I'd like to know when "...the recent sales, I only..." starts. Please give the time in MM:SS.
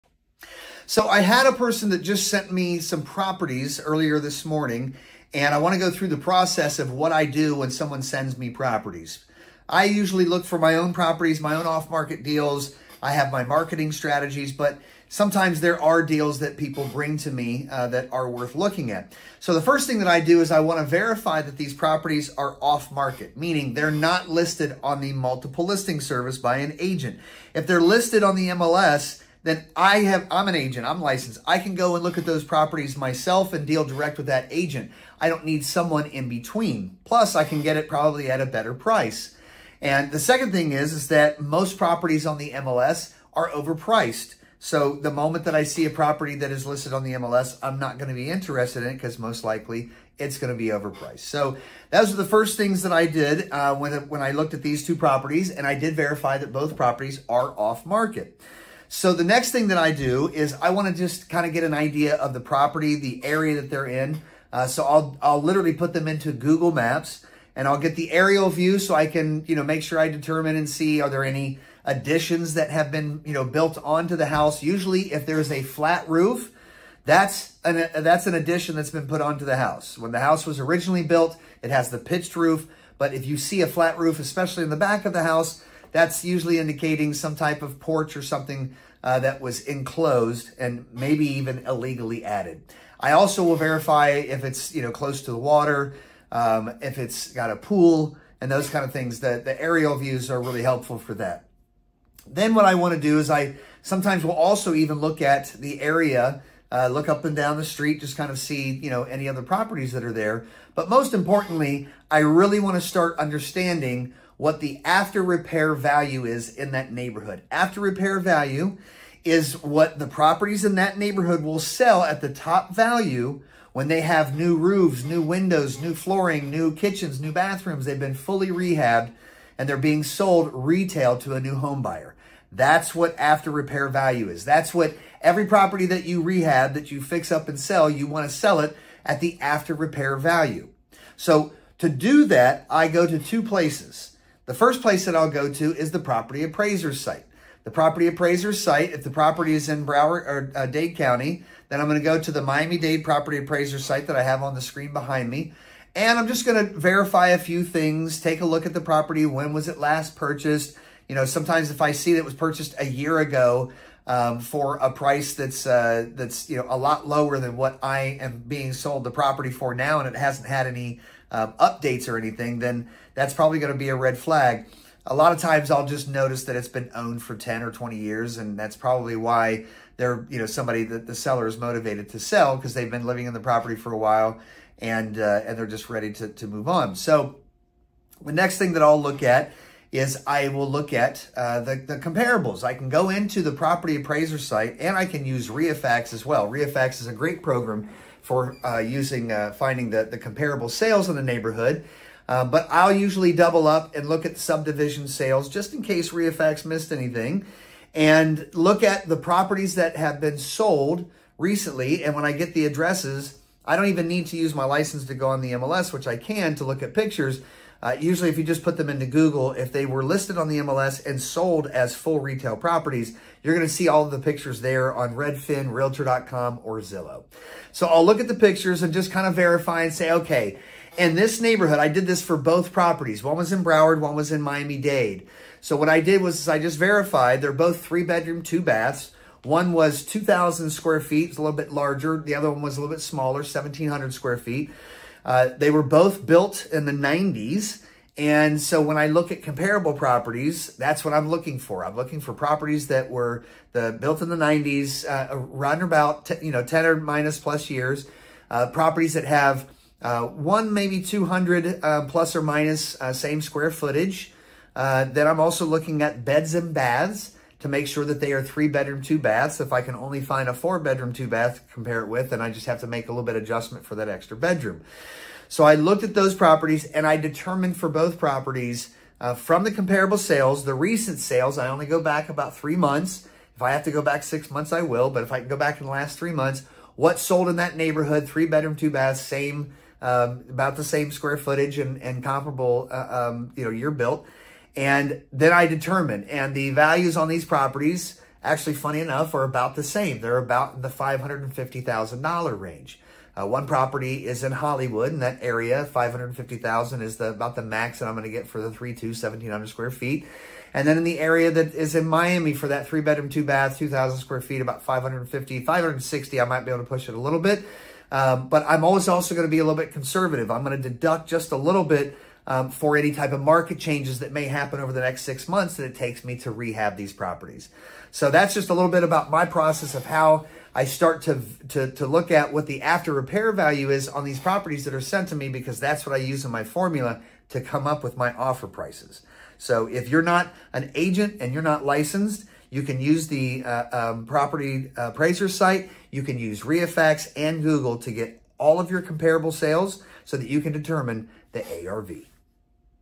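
04:40.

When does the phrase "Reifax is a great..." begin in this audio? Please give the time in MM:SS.
03:16.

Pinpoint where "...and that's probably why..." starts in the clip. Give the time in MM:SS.
02:58.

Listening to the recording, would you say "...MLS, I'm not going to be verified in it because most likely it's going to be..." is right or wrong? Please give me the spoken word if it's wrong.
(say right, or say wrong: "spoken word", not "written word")
wrong: "interested", not "verified".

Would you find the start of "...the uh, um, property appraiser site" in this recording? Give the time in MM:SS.
05:43.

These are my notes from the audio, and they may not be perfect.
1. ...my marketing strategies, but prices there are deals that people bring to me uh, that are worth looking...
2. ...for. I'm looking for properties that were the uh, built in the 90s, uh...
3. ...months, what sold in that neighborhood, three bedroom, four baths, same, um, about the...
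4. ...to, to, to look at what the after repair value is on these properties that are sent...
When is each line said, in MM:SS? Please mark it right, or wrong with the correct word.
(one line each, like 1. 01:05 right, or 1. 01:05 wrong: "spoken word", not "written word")
1. 00:13 wrong: "sometimes", not "prices"
2. 04:11 right
3. 04:46 wrong: "two", not "four"
4. 05:31 right.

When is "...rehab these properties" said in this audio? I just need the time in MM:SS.
05:26.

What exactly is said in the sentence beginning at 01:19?
When the house was originally built, it has the pitched roof.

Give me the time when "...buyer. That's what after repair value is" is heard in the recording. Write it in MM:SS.
02:11.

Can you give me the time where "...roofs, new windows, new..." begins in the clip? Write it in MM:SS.
02:04.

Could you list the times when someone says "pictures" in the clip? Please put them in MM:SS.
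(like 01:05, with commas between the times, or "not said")
03:36, 03:44, 03:48.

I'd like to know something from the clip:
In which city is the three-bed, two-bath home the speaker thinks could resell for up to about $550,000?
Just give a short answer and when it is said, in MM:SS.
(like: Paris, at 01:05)
Hollywood, at 05:04.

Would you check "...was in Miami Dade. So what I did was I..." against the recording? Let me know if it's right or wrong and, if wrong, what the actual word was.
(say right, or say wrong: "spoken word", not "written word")
right.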